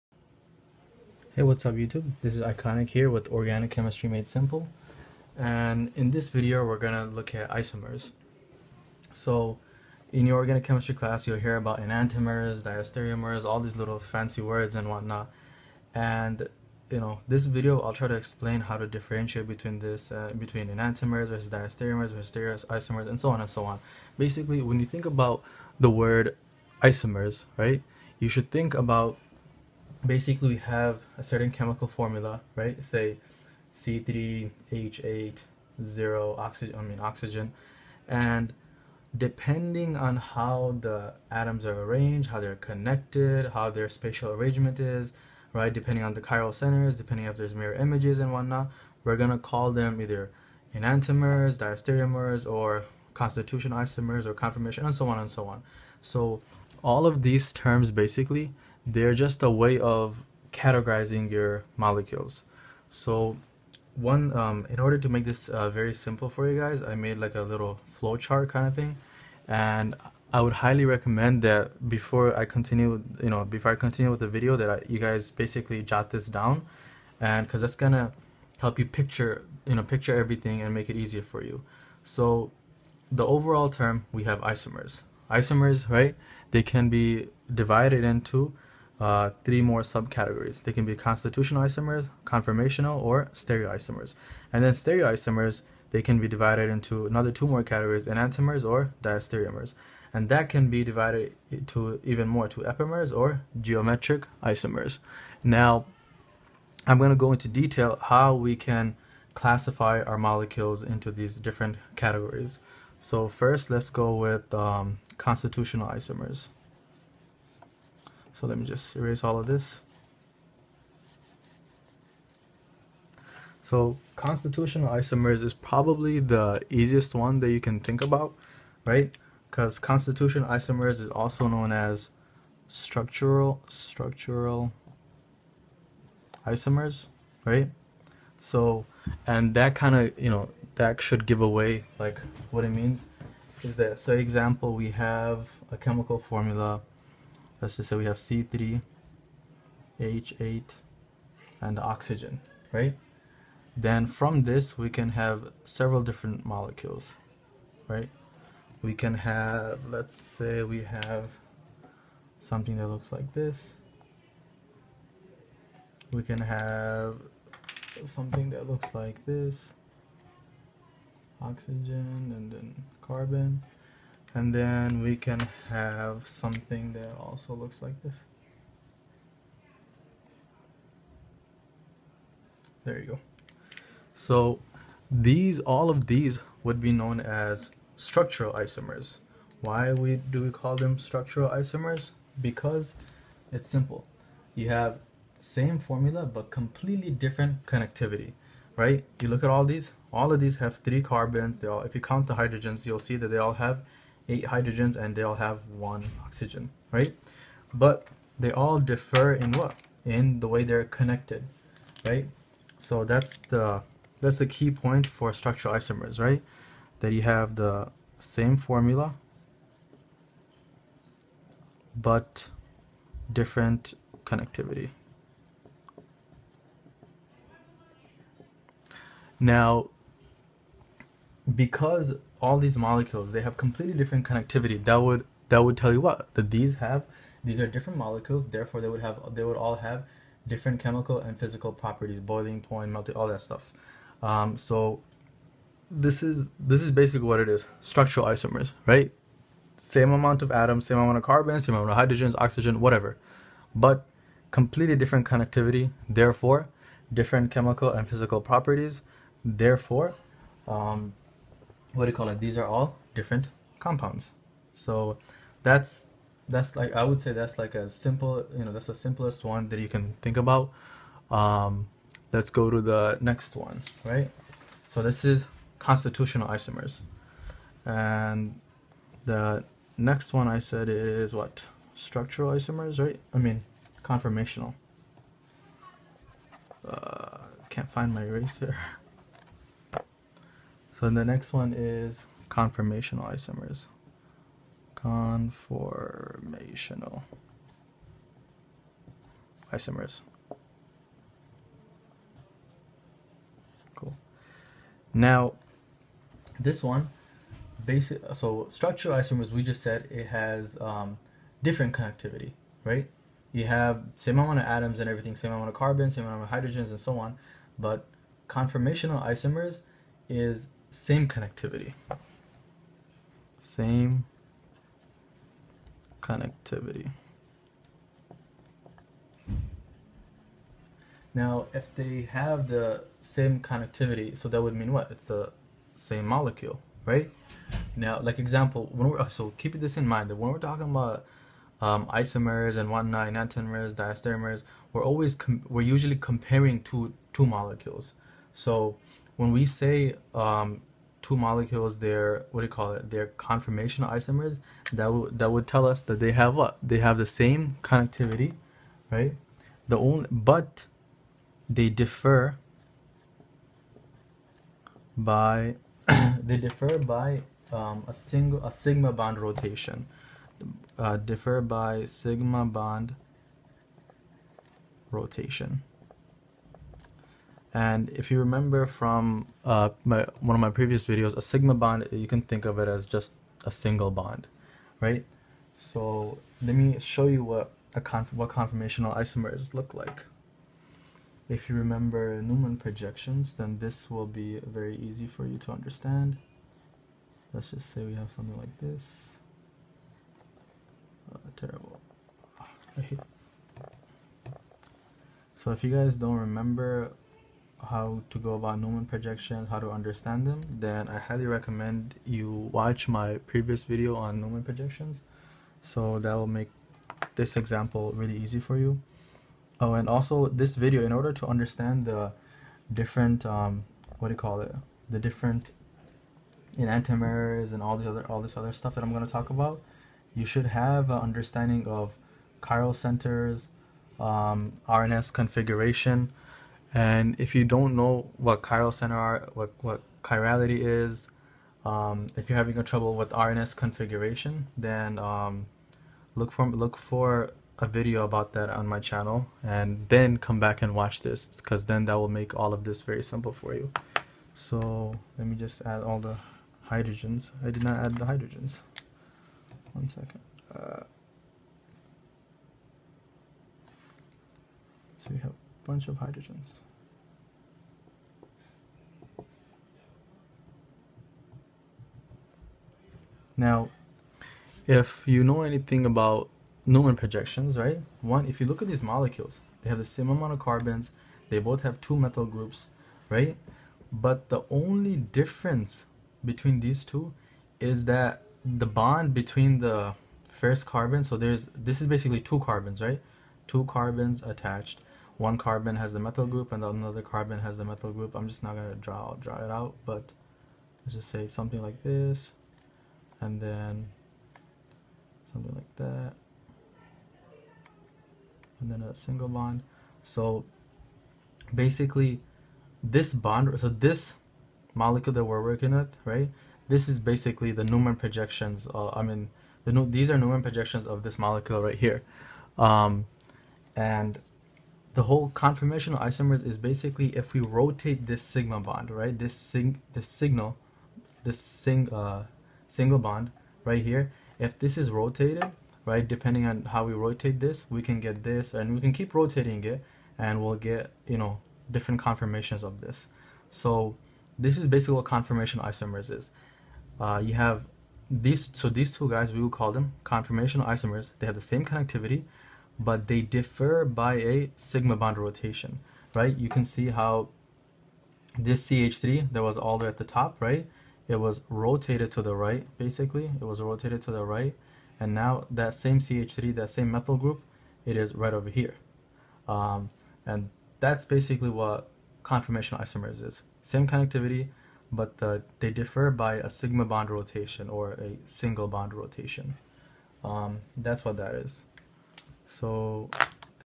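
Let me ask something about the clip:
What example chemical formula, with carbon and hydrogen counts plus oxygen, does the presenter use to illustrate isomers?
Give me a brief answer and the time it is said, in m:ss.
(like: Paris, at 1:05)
C3H8O, at 0:33.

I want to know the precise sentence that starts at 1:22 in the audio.
So the overall term, we have isomers.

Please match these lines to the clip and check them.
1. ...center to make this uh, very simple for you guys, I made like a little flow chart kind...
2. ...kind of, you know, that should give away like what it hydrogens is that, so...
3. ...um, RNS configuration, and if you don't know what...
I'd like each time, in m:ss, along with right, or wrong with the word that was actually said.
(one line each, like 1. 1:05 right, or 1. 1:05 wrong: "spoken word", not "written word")
1. 1:04 wrong: "order", not "center"
2. 2:19 wrong: "means", not "hydrogens"
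3. 7:14 right.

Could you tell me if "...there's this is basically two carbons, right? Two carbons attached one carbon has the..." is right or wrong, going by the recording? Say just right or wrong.
right.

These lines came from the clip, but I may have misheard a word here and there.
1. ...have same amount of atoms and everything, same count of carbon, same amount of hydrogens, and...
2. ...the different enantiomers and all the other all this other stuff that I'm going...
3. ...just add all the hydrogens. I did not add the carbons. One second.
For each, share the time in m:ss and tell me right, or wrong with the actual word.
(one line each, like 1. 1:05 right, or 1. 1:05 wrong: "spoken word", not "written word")
1. 5:13 wrong: "amount", not "count"
2. 7:05 right
3. 7:35 wrong: "hydrogens", not "carbons".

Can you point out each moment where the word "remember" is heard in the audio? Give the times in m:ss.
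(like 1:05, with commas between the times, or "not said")
6:18, 6:31, 6:46.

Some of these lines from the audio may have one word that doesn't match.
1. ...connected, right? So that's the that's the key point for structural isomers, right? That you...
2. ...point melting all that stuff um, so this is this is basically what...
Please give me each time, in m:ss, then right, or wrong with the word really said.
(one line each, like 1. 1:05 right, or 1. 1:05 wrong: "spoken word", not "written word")
1. 3:30 right
2. 4:02 right.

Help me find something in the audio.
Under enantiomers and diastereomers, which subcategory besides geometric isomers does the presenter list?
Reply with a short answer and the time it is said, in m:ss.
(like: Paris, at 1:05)
Epimers, at 1:42.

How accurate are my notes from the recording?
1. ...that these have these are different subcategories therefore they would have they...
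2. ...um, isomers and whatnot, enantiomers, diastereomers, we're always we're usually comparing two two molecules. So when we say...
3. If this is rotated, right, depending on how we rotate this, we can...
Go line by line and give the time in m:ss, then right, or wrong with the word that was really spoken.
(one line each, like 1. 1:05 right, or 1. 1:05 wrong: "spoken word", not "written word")
1. 3:56 wrong: "molecules", not "subcategories"
2. 5:41 right
3. 8:54 right.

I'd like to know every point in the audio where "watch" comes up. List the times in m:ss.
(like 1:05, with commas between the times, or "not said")
6:52, 7:30.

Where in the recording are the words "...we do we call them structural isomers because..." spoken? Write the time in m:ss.
3:09.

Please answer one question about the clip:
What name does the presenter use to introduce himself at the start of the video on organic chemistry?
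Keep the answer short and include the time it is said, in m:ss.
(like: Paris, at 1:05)
Iconic, at 0:02.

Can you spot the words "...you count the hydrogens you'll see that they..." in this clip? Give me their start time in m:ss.
3:21.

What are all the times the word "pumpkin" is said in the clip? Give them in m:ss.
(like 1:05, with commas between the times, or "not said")
not said.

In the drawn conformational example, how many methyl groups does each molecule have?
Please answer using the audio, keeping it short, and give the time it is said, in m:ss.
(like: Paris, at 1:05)
2, at 8:02.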